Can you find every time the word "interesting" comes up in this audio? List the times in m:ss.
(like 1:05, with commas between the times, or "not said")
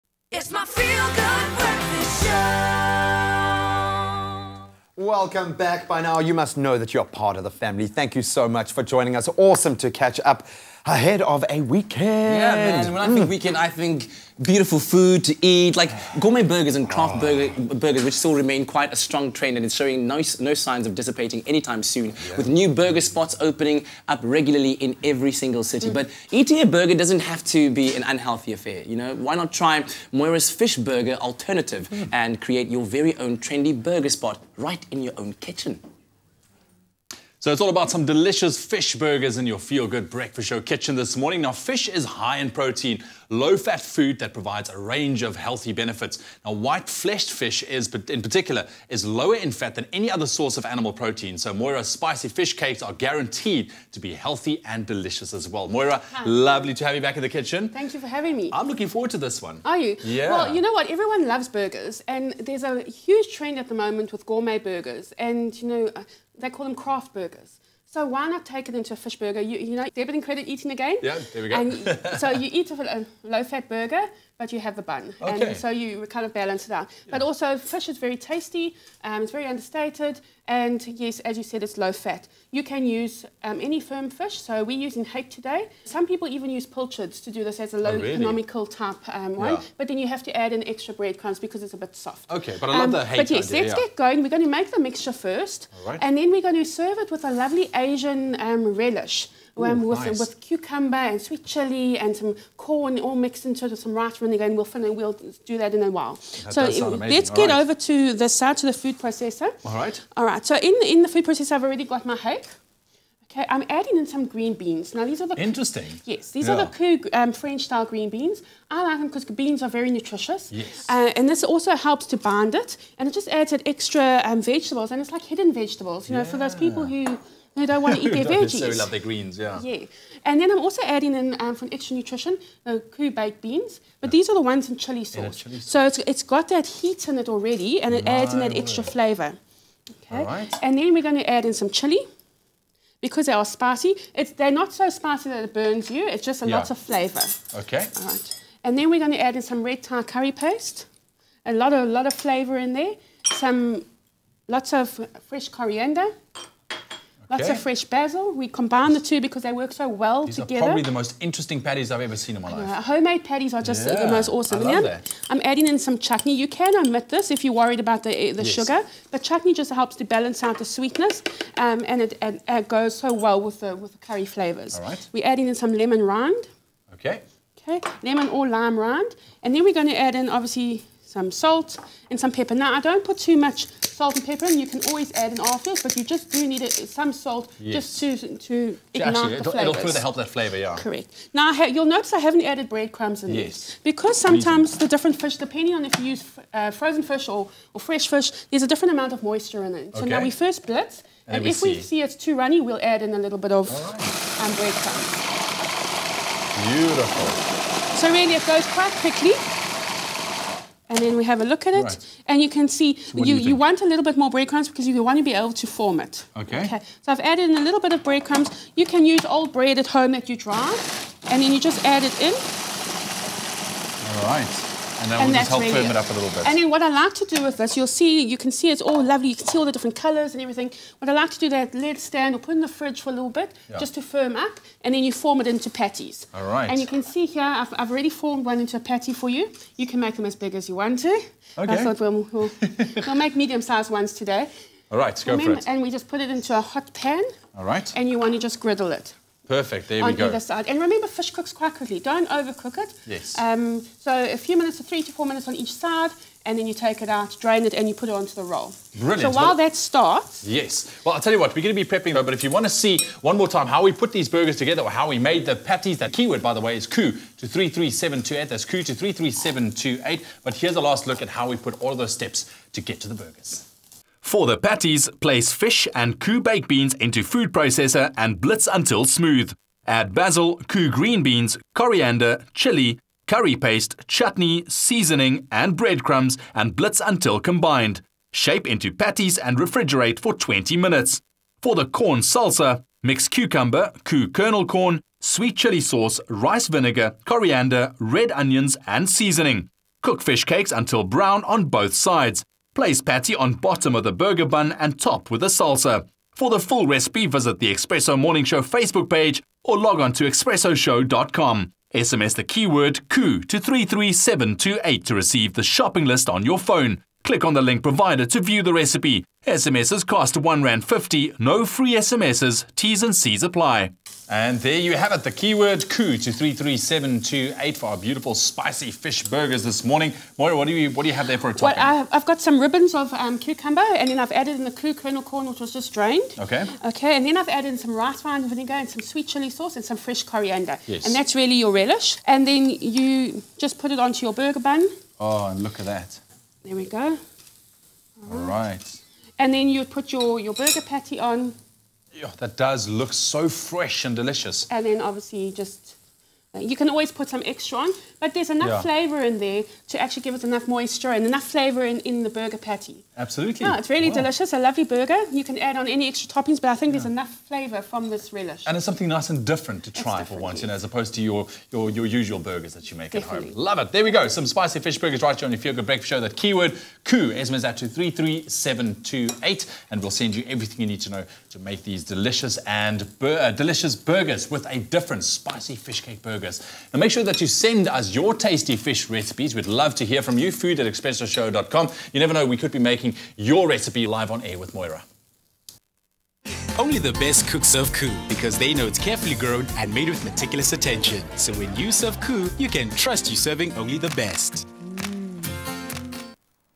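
1:55, 2:41.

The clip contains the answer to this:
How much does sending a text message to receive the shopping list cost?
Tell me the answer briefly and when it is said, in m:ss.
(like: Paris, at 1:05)
1 rand 50, at 5:20.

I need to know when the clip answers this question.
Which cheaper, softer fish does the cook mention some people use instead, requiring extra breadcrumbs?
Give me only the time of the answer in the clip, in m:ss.
1:26.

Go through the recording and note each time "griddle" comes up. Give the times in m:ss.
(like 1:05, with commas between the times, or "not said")
4:08.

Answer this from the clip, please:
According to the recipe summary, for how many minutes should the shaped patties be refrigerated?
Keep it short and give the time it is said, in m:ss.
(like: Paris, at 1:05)
20 minutes, at 4:50.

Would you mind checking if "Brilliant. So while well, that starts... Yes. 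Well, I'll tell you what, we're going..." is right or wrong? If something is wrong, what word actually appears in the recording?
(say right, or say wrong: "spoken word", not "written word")
right.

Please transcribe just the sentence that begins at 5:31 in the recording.
Well, I've got some ribbons of um, cucumber, and then I've added in the Koo kernel corn, which was just drained.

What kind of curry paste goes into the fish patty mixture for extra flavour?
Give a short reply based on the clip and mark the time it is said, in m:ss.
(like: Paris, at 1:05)
Red Thai curry paste, at 2:29.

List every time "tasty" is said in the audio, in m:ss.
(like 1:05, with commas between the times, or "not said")
1:18, 6:28.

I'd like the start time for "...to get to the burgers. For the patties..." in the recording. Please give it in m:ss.
4:32.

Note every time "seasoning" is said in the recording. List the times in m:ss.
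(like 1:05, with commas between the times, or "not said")
4:44, 4:59.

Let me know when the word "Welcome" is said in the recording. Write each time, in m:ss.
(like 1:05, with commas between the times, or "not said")
0:04.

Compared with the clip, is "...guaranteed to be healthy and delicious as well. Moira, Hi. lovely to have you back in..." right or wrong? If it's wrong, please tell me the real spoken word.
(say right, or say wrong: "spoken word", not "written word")
right.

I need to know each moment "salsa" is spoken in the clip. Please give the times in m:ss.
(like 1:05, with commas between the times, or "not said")
4:52, 5:05.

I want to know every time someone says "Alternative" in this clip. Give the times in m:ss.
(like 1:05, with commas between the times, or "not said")
0:31.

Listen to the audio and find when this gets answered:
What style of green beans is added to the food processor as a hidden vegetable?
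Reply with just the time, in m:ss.
1:57.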